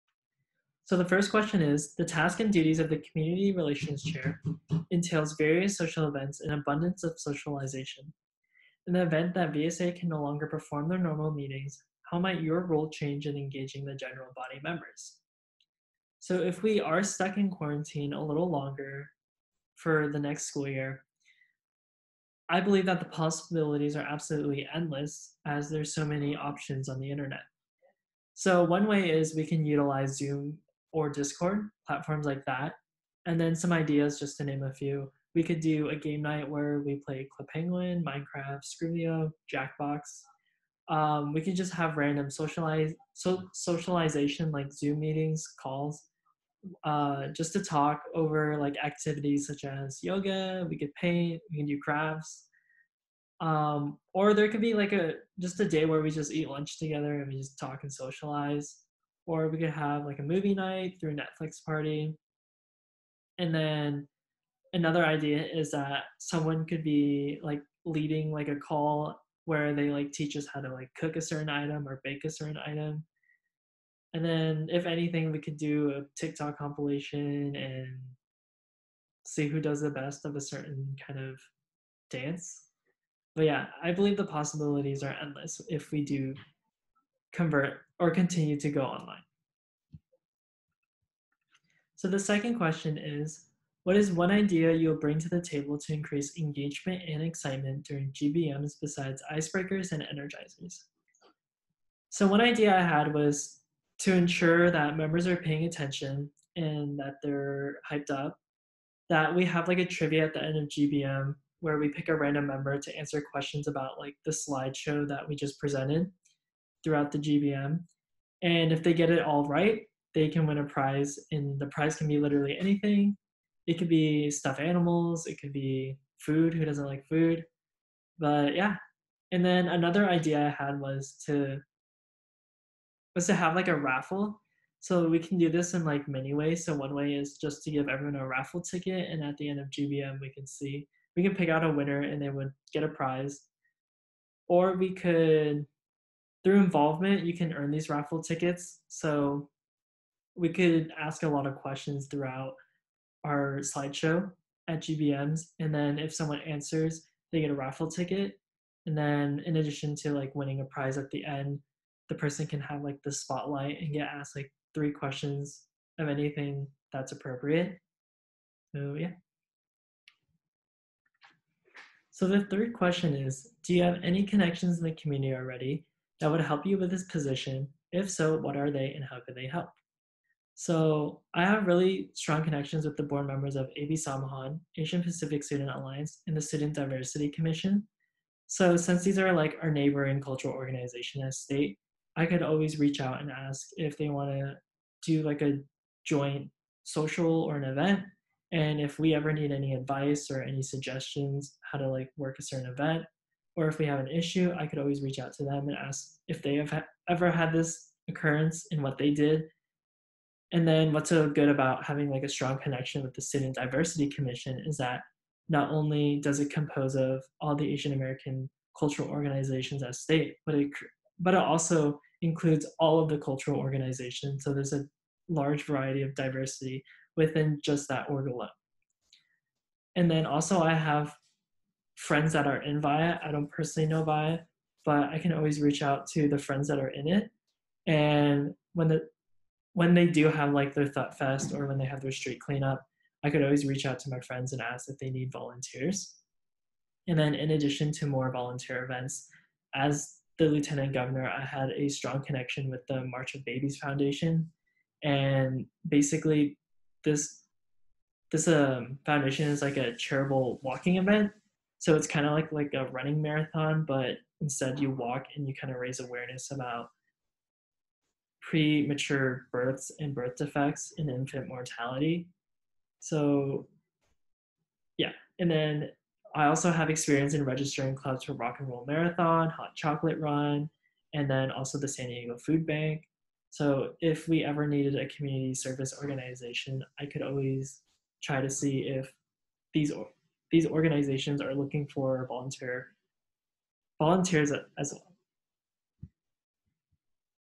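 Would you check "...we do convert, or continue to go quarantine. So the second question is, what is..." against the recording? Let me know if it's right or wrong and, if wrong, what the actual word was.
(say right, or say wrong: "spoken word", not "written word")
wrong: "online", not "quarantine".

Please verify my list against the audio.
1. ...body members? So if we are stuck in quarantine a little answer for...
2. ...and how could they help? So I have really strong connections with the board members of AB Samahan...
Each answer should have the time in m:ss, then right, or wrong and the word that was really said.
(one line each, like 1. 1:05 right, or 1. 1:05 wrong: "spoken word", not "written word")
1. 0:14 wrong: "longer", not "answer"
2. 2:58 right.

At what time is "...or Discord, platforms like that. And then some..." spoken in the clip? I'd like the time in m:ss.
0:30.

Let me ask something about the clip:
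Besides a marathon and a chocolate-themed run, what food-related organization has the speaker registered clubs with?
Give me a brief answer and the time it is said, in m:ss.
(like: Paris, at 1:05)
San Diego Food Bank, at 4:41.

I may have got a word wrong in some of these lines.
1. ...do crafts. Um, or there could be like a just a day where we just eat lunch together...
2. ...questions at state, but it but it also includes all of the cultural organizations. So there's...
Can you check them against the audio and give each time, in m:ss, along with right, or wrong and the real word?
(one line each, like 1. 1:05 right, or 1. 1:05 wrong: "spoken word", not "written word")
1. 0:51 right
2. 3:39 wrong: "organizations", not "questions".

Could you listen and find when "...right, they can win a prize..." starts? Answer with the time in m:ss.
1:59.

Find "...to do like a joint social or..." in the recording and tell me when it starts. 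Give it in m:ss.
3:14.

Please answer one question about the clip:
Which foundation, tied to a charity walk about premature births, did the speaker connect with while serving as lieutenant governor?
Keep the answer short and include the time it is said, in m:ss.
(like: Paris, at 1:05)
March of Babies Foundation, at 4:13.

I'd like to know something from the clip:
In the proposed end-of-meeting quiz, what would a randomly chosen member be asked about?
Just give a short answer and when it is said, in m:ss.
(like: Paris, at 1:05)
The slideshow, at 1:54.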